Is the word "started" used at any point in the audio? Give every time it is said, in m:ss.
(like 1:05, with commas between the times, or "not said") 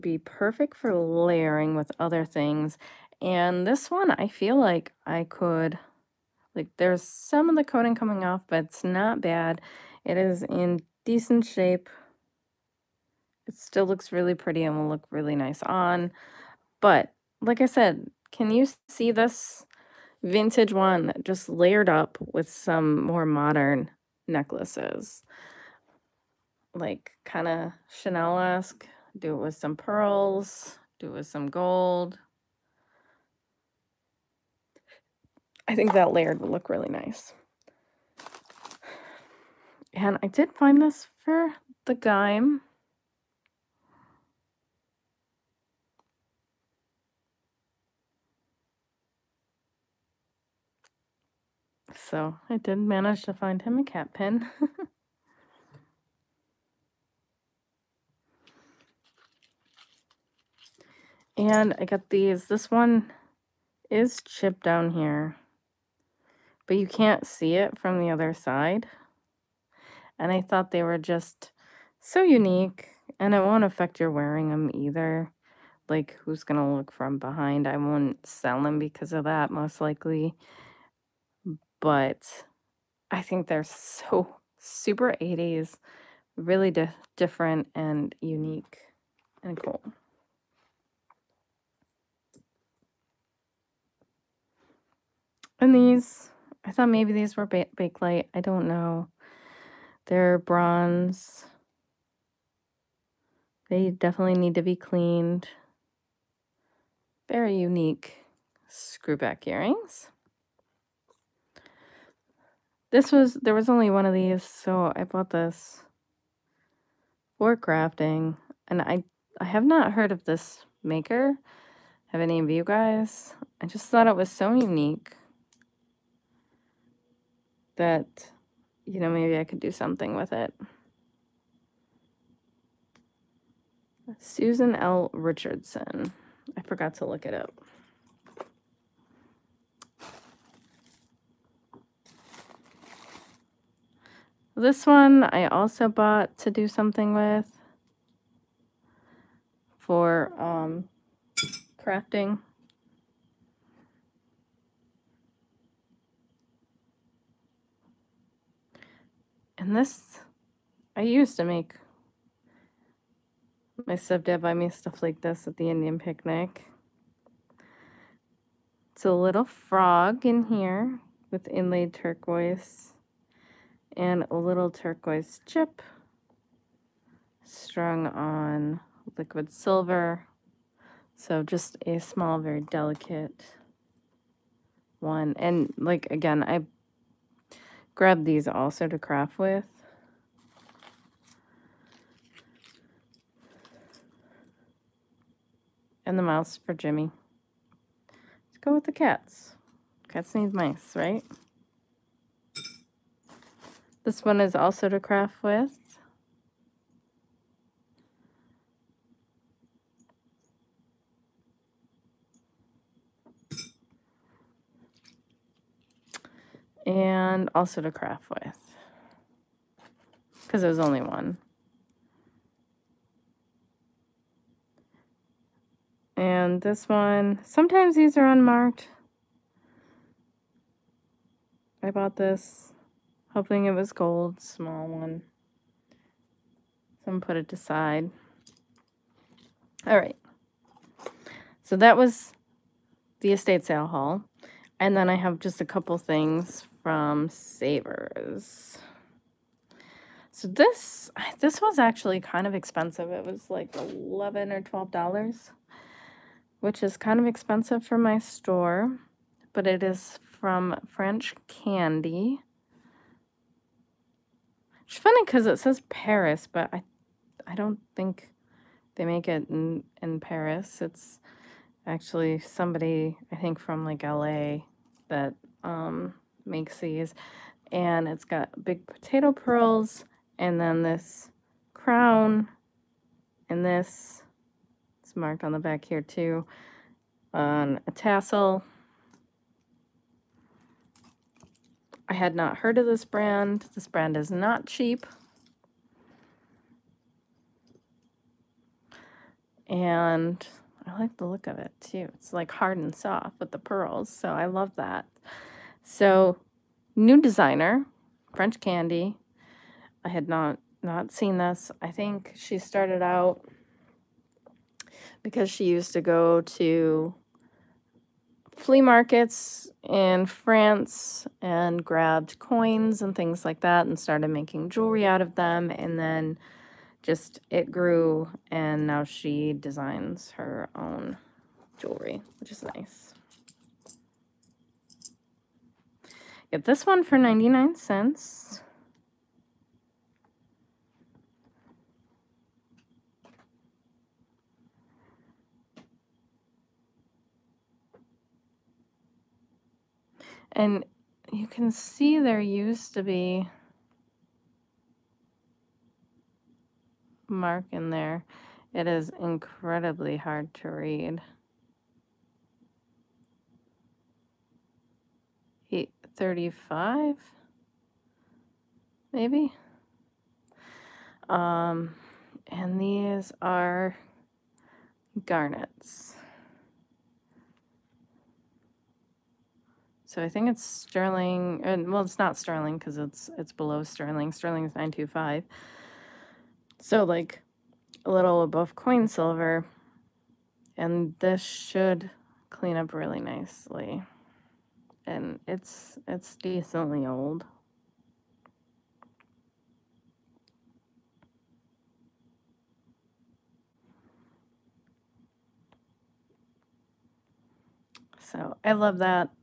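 5:12, 5:23.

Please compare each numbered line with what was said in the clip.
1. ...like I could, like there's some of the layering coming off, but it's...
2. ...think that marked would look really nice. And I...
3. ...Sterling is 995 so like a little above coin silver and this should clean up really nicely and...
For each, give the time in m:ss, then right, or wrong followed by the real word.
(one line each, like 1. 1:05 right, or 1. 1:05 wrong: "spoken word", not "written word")
1. 0:04 wrong: "coating", not "layering"
2. 0:35 wrong: "layered", not "marked"
3. 6:24 wrong: "925", not "995".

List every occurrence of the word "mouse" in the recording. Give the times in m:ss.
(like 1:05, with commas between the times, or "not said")
3:16.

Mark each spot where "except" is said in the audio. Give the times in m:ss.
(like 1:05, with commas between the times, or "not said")
not said.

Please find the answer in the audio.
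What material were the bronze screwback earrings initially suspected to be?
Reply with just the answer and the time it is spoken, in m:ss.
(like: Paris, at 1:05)
Bakelite, at 1:37.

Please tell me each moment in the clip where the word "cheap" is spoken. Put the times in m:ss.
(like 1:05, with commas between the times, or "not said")
4:54.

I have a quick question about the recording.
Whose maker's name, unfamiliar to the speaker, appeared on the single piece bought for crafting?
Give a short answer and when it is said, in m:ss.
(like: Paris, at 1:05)
Susan L. Richardson, at 2:14.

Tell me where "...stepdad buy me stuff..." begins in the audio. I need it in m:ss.
2:43.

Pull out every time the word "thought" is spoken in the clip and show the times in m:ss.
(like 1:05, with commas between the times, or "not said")
1:10, 1:36, 2:03.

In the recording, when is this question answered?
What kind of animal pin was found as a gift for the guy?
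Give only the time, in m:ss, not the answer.
0:53.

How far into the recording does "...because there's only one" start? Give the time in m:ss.
3:40.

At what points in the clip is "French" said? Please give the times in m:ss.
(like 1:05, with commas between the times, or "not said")
4:20, 5:08.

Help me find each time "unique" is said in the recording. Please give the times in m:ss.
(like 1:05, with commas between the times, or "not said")
1:12, 1:28, 1:47, 2:04.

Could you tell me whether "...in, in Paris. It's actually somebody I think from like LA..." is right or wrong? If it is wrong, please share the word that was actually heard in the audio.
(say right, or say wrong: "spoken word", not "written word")
right.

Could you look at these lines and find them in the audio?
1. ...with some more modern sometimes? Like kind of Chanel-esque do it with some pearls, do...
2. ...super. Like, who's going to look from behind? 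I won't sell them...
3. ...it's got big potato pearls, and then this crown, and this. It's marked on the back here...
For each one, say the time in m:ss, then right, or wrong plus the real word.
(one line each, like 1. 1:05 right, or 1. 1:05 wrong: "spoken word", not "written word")
1. 0:22 wrong: "necklaces", not "sometimes"
2. 1:14 wrong: "either", not "super"
3. 4:38 right.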